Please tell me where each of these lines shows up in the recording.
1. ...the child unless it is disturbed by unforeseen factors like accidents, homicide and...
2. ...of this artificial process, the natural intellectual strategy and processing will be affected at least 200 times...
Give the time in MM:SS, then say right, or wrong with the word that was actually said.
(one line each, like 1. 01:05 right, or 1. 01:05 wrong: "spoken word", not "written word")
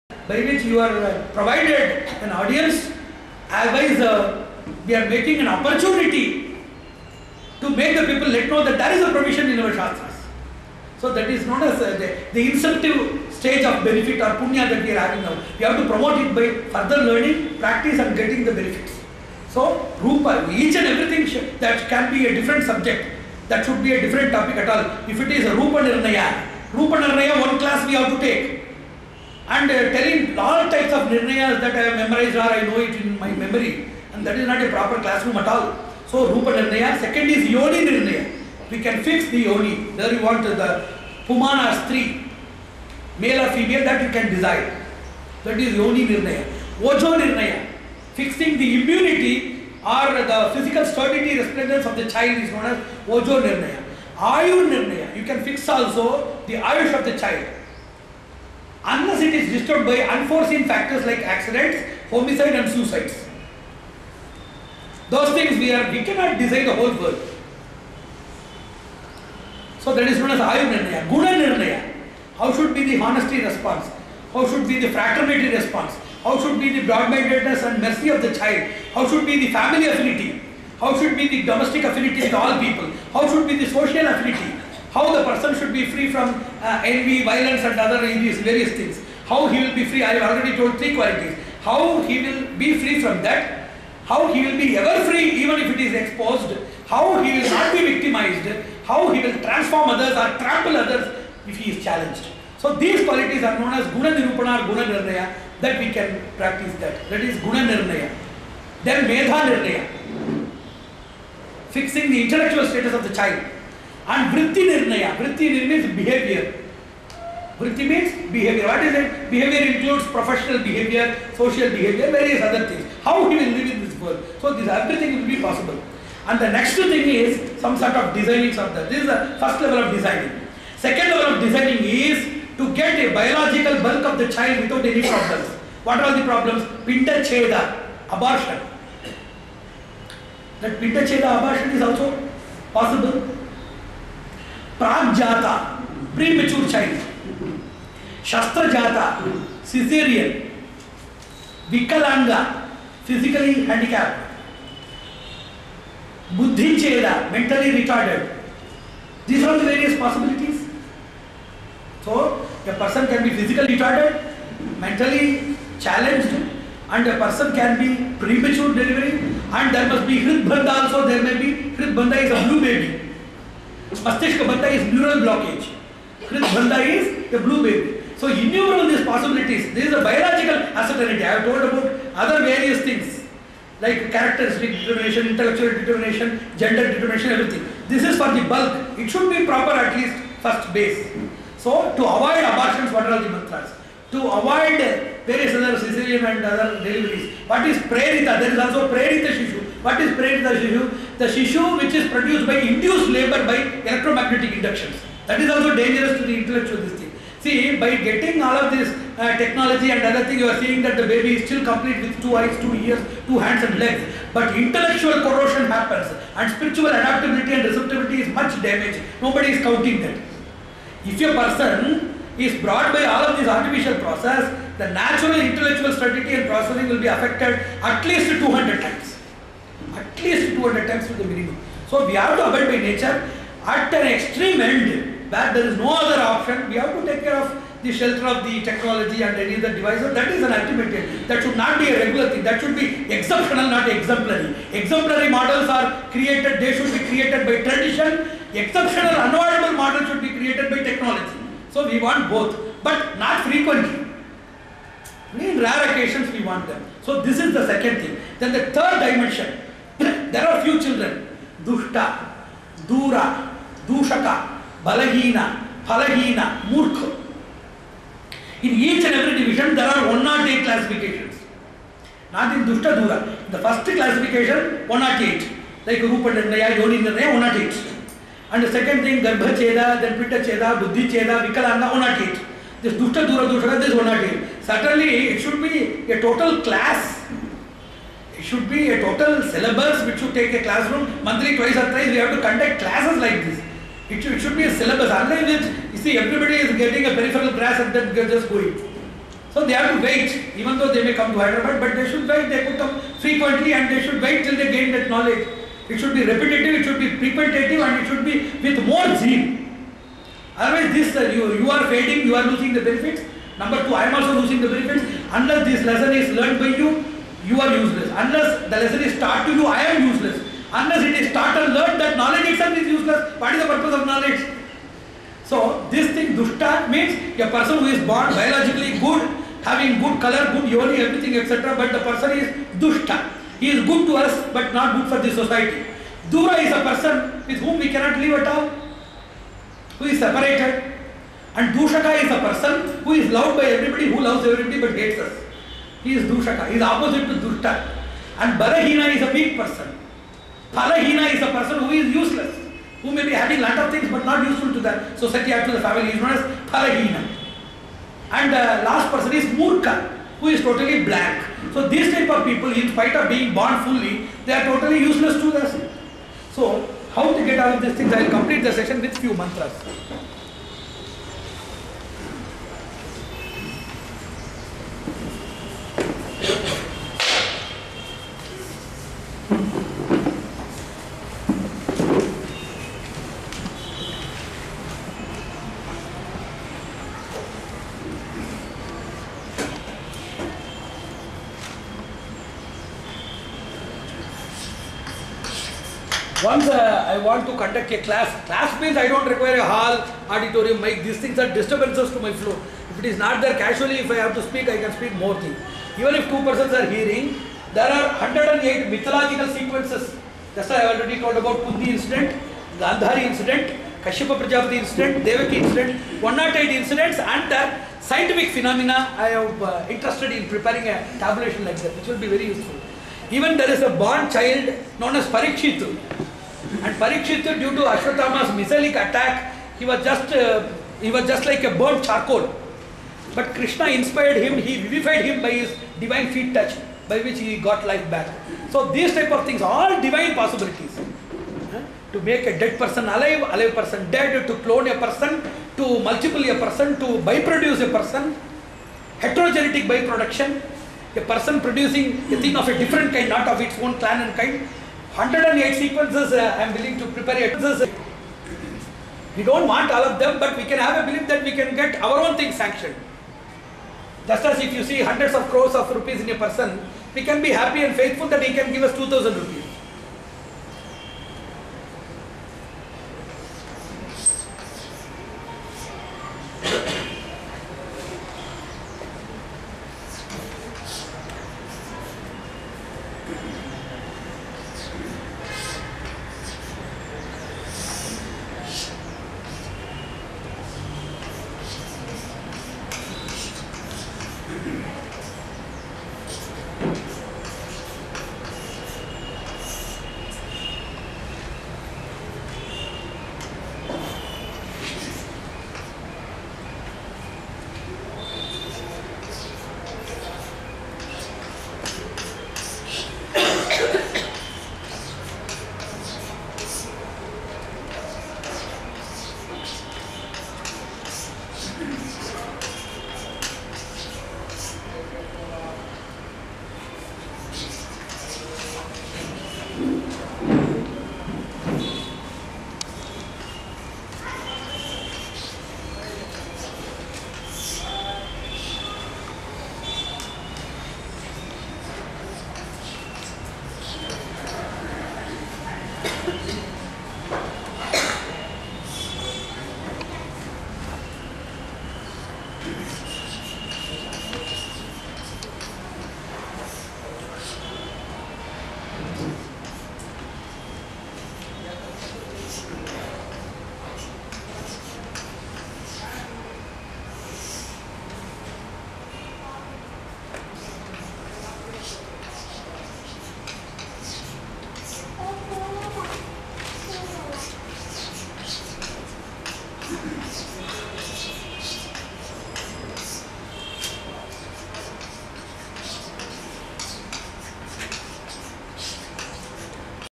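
1. 00:57 right
2. 03:43 right.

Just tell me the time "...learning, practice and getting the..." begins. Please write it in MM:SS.
00:17.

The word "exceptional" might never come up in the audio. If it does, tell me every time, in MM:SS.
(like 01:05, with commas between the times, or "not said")
04:03, 04:08.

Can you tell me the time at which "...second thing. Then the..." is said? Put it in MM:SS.
04:17.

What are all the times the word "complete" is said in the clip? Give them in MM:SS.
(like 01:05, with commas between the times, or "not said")
03:31, 06:08.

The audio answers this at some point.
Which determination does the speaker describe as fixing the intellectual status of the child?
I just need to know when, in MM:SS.
01:49.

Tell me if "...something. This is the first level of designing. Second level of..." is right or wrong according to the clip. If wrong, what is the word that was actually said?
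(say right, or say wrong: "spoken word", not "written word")
right.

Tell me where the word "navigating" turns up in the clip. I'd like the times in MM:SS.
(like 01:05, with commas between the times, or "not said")
not said.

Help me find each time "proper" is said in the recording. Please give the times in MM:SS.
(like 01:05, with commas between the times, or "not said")
00:34, 03:09.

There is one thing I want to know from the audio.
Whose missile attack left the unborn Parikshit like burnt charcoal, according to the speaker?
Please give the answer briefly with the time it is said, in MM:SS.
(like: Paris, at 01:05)
Ashwathama, at 07:07.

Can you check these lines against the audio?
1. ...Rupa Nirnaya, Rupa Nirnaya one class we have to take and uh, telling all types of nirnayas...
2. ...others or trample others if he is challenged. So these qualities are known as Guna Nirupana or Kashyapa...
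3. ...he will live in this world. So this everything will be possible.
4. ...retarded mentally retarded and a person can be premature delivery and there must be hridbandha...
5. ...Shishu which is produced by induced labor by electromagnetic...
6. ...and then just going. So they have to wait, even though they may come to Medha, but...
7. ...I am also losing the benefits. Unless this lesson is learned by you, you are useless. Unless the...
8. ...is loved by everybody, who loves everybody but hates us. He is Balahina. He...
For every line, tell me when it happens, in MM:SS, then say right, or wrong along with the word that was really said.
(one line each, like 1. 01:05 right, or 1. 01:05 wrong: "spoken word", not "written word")
1. 00:25 right
2. 01:39 wrong: "Guna", not "Kashyapa"
3. 02:03 right
4. 02:43 wrong: "challenged", not "retarded"
5. 03:21 right
6. 04:57 wrong: "Hyderabad", not "Medha"
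7. 05:13 right
8. 05:43 wrong: "Dushaka", not "Balahina".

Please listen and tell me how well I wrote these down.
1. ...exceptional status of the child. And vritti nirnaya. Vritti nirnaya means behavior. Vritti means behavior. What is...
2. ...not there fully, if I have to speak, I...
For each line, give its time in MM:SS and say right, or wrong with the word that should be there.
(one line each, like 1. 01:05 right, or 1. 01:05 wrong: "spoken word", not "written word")
1. 01:52 wrong: "intellectual", not "exceptional"
2. 06:43 wrong: "casually", not "fully".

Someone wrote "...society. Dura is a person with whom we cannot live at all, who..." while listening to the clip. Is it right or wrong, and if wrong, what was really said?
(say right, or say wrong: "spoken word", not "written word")
right.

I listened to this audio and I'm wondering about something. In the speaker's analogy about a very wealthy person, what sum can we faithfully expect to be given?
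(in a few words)
2000 rupees.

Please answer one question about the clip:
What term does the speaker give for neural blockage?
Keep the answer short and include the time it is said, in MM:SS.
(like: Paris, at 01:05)
Mastishka Bandha, at 02:53.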